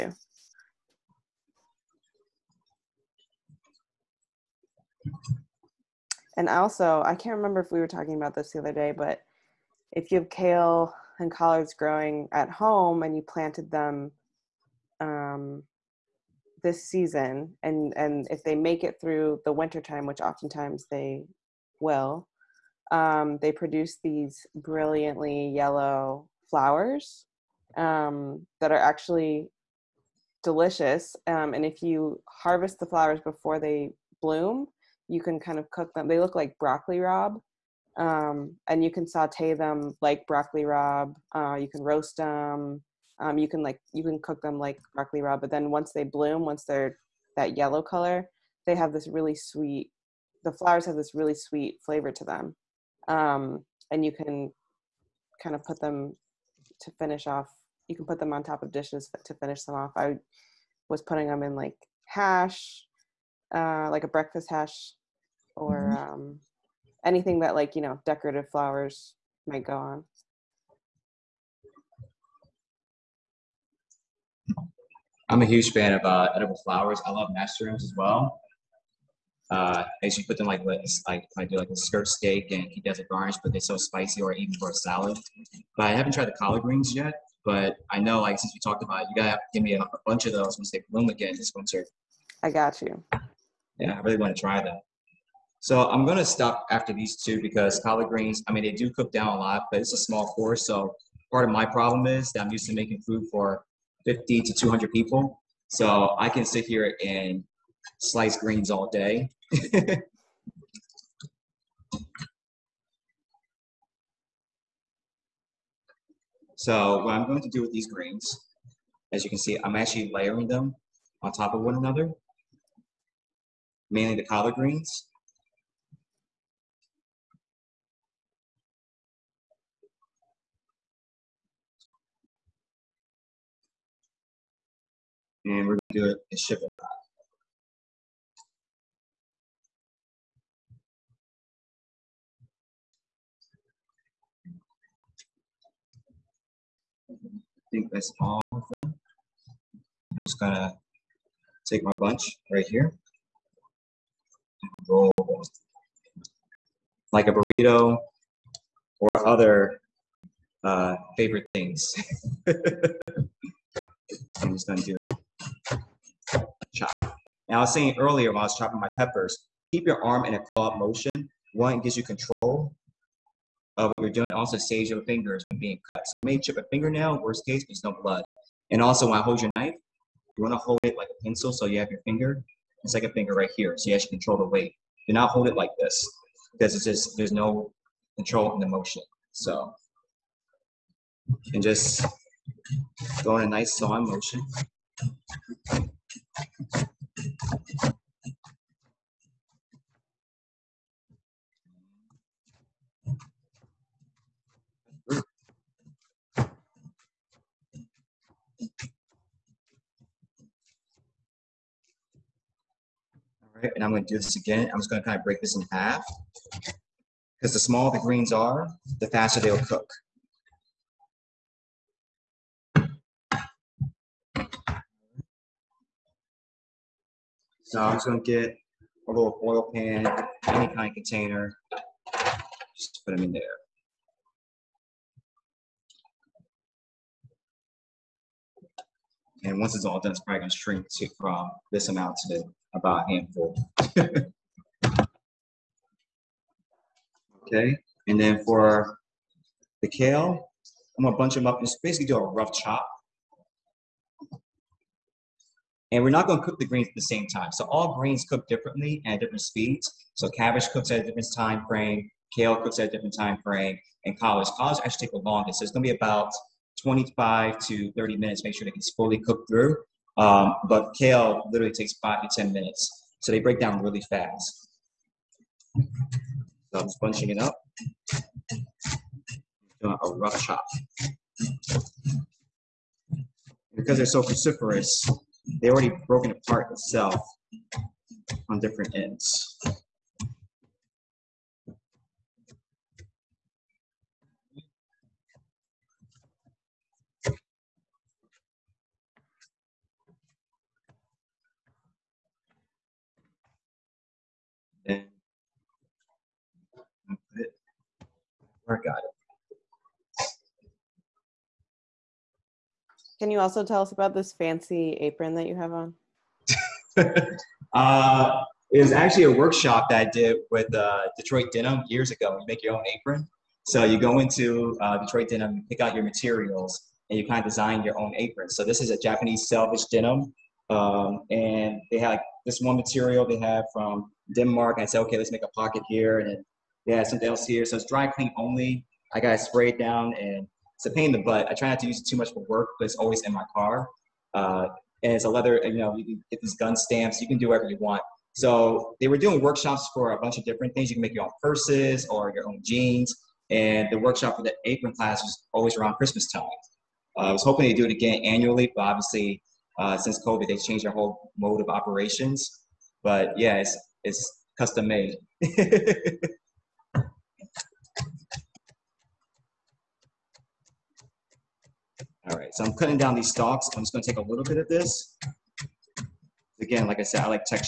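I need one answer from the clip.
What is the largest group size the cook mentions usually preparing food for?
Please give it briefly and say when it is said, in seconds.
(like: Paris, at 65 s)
200, at 104 s.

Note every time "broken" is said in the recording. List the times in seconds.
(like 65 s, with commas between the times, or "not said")
286 s.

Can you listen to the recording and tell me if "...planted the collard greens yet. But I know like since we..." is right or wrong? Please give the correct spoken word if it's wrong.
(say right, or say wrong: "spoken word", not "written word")
wrong: "tried", not "planted".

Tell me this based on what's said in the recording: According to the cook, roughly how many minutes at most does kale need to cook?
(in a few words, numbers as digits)
10.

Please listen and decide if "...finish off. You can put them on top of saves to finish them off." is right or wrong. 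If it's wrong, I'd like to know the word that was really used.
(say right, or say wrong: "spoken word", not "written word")
wrong: "dishes", not "saves".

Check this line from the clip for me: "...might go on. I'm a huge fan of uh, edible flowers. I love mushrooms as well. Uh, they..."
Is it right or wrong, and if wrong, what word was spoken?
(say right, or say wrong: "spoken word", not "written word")
right.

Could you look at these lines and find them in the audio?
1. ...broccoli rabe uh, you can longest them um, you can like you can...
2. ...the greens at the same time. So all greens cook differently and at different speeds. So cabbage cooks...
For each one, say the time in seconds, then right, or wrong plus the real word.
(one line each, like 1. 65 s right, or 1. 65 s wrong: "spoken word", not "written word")
1. 40 s wrong: "roast", not "longest"
2. 256 s right.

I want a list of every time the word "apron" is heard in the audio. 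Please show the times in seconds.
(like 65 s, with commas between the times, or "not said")
314 s, 322 s, 328 s, 354 s.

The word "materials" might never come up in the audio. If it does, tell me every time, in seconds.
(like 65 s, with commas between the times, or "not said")
326 s, 332 s.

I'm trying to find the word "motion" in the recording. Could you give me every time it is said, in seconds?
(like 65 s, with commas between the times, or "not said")
170 s, 188 s, 194 s.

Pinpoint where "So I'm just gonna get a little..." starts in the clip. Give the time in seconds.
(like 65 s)
227 s.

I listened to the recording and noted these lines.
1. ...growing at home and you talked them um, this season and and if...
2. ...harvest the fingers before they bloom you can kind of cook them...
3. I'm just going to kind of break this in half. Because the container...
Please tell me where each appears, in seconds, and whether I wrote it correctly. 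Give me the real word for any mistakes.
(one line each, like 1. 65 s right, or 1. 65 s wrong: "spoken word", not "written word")
1. 11 s wrong: "planted", not "talked"
2. 32 s wrong: "flowers", not "fingers"
3. 214 s wrong: "smaller", not "container".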